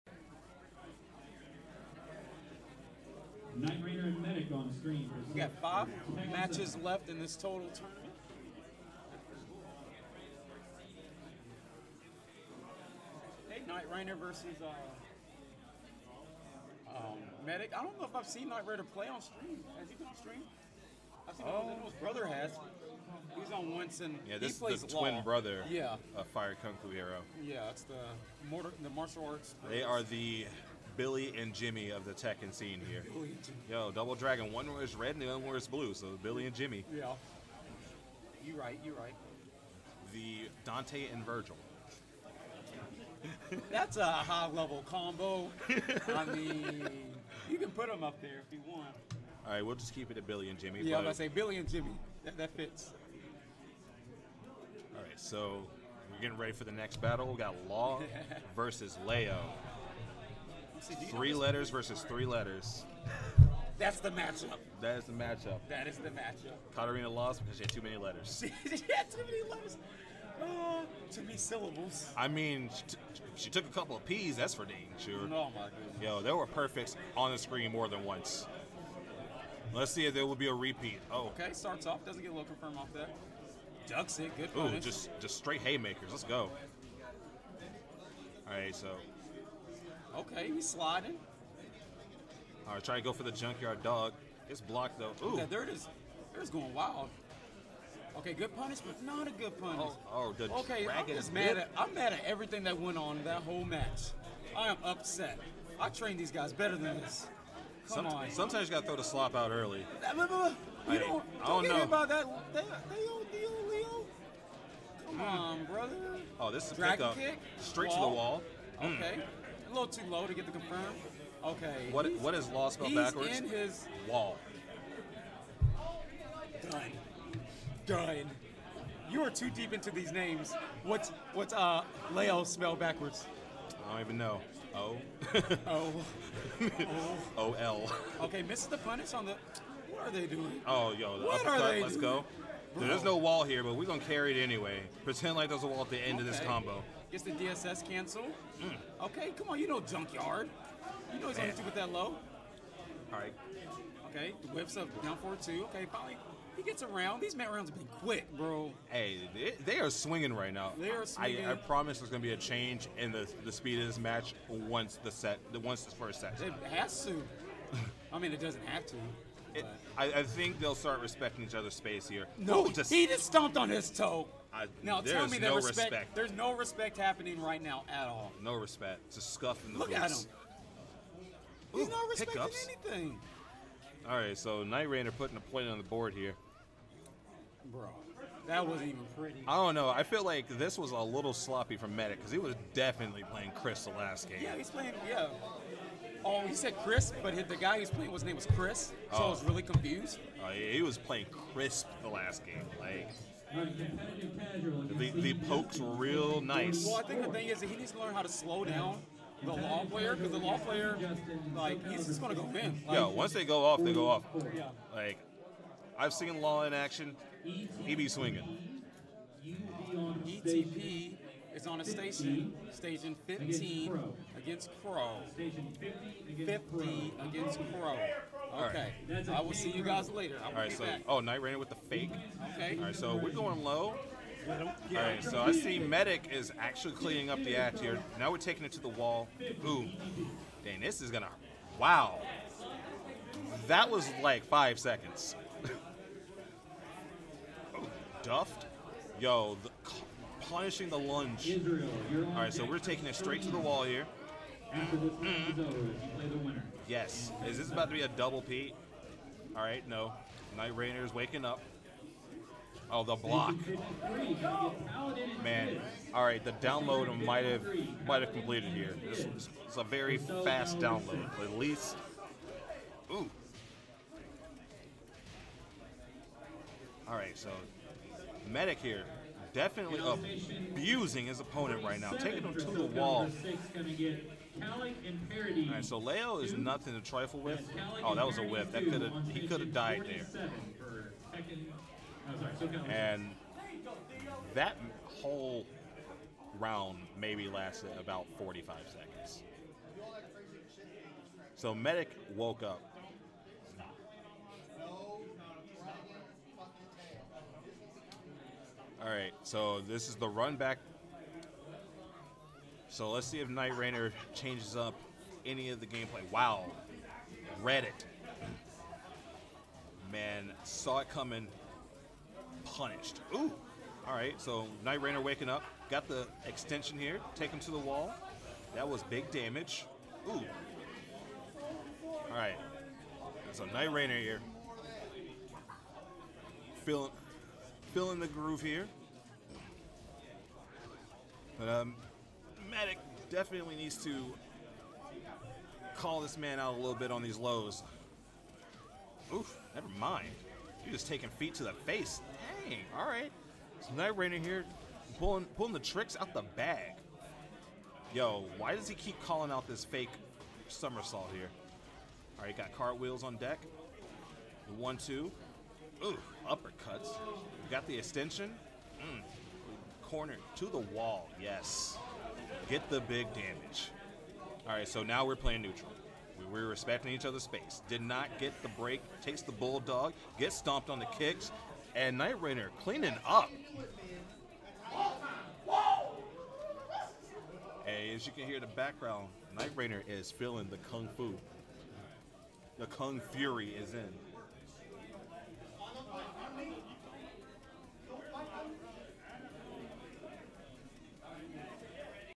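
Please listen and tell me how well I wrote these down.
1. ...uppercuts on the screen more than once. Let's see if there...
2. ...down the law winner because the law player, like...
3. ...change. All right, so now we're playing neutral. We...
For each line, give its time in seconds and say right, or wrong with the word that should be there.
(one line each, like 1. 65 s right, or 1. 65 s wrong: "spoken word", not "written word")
1. 76 s wrong: "perfects", not "uppercuts"
2. 208 s wrong: "player", not "winner"
3. 373 s wrong: "damage", not "change".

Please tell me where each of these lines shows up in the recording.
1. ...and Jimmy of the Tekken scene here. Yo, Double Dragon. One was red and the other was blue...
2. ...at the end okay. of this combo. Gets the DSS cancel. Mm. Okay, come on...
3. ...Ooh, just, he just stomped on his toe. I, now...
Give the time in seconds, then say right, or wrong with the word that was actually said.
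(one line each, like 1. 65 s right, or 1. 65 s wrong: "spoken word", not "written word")
1. 31 s right
2. 145 s right
3. 172 s right.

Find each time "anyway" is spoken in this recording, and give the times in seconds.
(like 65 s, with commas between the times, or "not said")
144 s.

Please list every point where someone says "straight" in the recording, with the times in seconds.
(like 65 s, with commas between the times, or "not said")
85 s, 117 s, 253 s.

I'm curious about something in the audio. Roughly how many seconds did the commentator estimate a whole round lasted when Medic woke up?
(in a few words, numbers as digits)
45.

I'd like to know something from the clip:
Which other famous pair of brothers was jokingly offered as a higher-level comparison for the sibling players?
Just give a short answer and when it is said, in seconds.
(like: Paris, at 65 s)
Dante and Virgil, at 40 s.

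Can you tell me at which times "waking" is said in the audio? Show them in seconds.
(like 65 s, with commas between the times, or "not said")
261 s, 325 s.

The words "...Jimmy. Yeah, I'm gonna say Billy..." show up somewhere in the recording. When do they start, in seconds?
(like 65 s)
50 s.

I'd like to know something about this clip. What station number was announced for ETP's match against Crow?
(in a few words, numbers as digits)
15.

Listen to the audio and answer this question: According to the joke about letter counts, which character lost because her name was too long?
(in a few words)
Katarina.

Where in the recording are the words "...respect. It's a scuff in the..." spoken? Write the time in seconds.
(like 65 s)
178 s.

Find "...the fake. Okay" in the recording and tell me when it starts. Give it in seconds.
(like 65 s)
231 s.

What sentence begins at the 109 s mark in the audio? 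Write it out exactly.
You I, don't, I don't know about that.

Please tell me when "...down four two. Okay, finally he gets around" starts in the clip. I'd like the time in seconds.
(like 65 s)
155 s.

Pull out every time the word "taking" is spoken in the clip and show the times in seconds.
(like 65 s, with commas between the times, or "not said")
238 s, 252 s, 282 s, 351 s.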